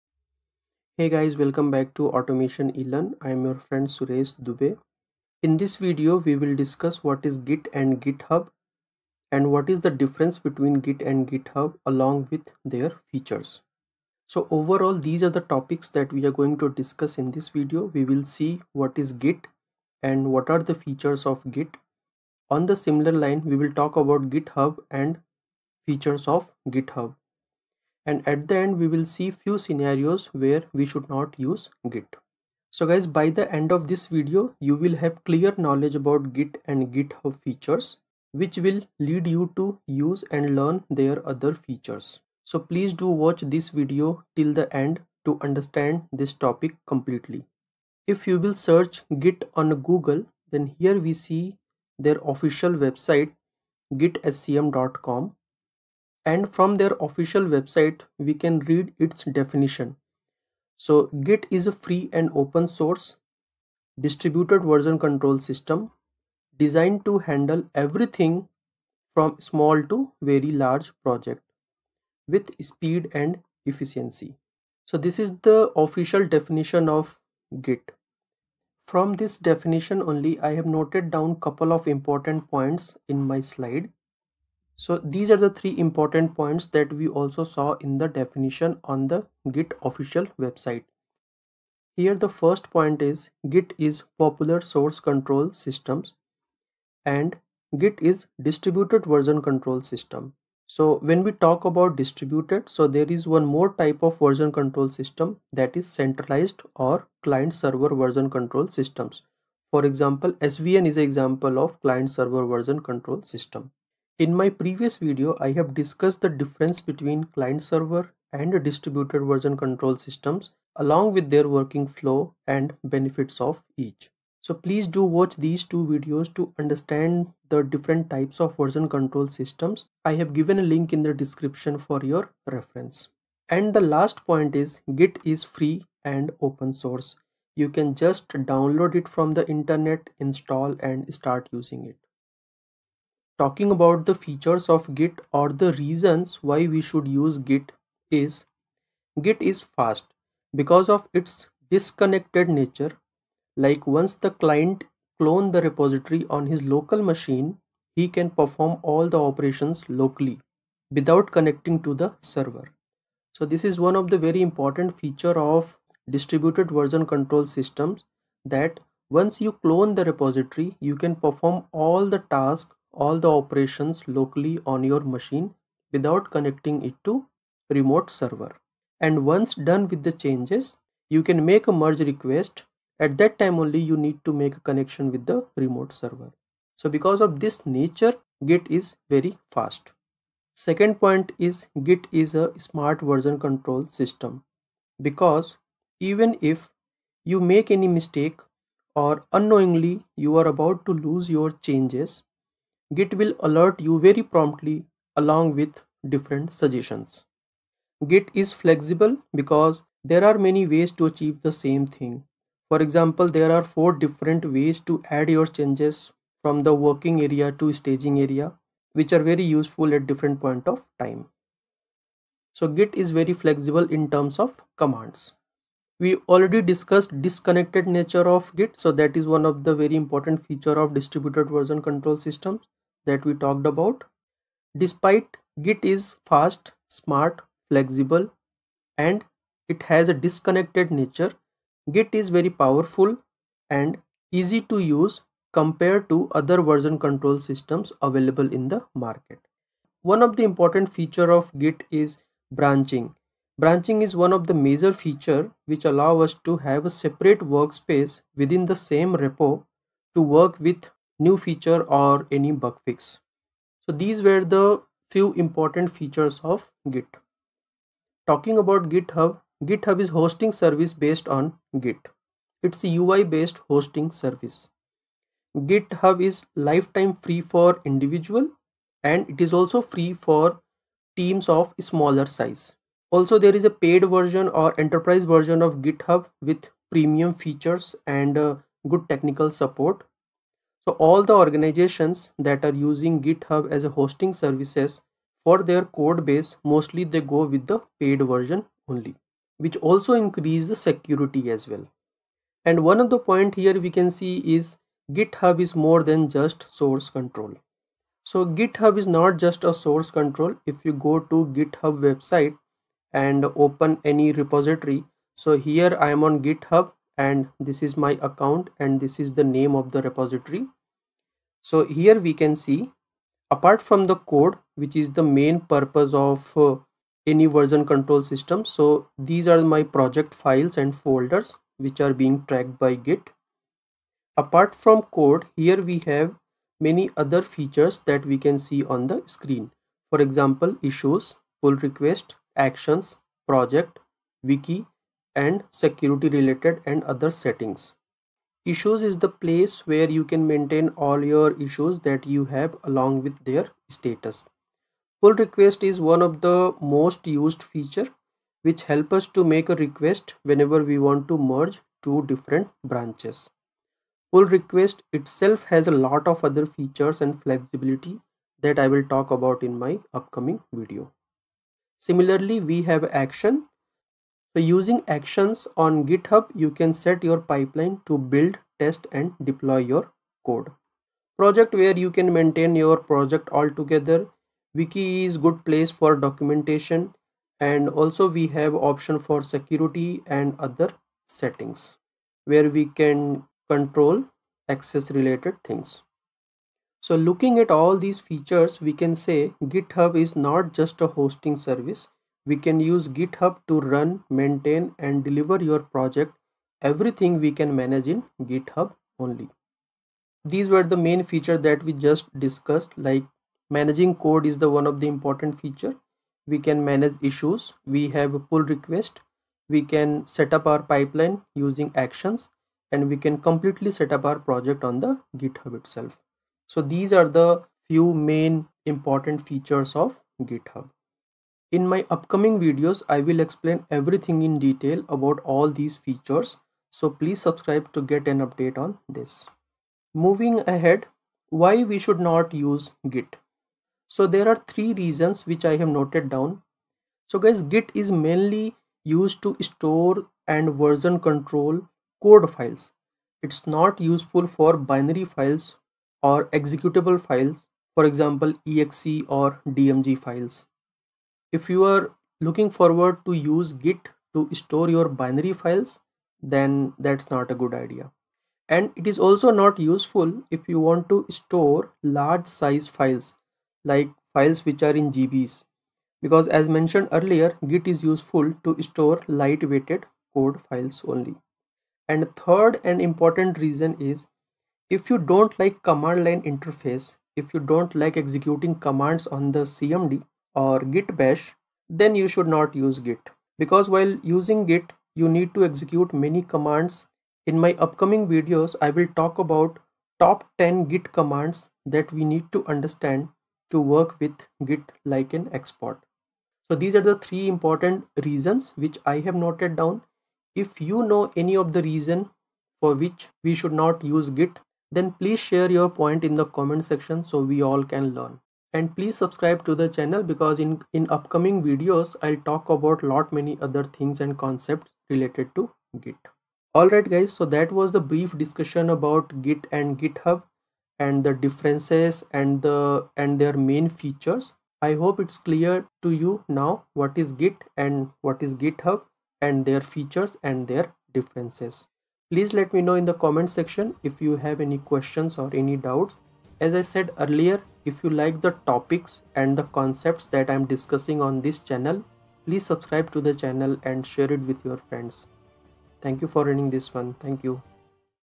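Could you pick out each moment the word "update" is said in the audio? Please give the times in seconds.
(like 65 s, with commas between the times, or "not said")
438 s.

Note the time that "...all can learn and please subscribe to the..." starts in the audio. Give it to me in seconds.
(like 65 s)
517 s.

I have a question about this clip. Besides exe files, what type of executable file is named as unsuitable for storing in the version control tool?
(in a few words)
DMG.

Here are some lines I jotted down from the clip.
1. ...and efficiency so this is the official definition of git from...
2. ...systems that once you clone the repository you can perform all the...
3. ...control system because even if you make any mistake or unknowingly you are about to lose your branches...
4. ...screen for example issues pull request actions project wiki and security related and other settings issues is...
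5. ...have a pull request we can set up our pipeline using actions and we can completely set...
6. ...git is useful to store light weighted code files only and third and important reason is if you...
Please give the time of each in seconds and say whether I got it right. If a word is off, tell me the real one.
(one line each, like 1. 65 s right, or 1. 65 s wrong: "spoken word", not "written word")
1. 73 s right
2. 167 s right
3. 193 s wrong: "changes", not "branches"
4. 339 s right
5. 418 s right
6. 477 s right.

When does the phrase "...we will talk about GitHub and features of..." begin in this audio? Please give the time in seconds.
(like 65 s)
23 s.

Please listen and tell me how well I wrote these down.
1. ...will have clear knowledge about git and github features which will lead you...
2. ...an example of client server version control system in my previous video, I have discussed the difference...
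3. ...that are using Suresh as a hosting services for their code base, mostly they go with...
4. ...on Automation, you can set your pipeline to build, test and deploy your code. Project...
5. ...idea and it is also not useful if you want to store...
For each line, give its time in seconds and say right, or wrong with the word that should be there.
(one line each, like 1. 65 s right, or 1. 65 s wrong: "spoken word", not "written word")
1. 34 s right
2. 110 s right
3. 292 s wrong: "GitHub", not "Suresh"
4. 375 s wrong: "GitHub", not "Automation"
5. 467 s right.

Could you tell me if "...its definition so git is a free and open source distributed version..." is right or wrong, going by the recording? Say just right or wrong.
right.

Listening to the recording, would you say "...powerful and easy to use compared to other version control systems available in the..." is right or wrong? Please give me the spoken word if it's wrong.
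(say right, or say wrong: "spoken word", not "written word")
right.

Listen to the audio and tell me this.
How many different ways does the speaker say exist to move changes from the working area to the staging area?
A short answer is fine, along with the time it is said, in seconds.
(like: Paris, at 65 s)
4, at 213 s.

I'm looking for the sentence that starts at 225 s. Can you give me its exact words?
We already discussed disconnected nature of Git.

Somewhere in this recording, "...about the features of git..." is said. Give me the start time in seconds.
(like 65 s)
143 s.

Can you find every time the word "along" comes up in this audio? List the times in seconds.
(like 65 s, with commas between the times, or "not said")
11 s, 120 s, 205 s, 352 s.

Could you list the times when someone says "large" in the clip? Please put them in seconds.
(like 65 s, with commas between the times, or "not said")
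70 s, 472 s.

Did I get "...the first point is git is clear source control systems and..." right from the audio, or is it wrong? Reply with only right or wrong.
wrong.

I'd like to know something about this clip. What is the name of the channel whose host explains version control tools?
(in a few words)
Automation eLearn.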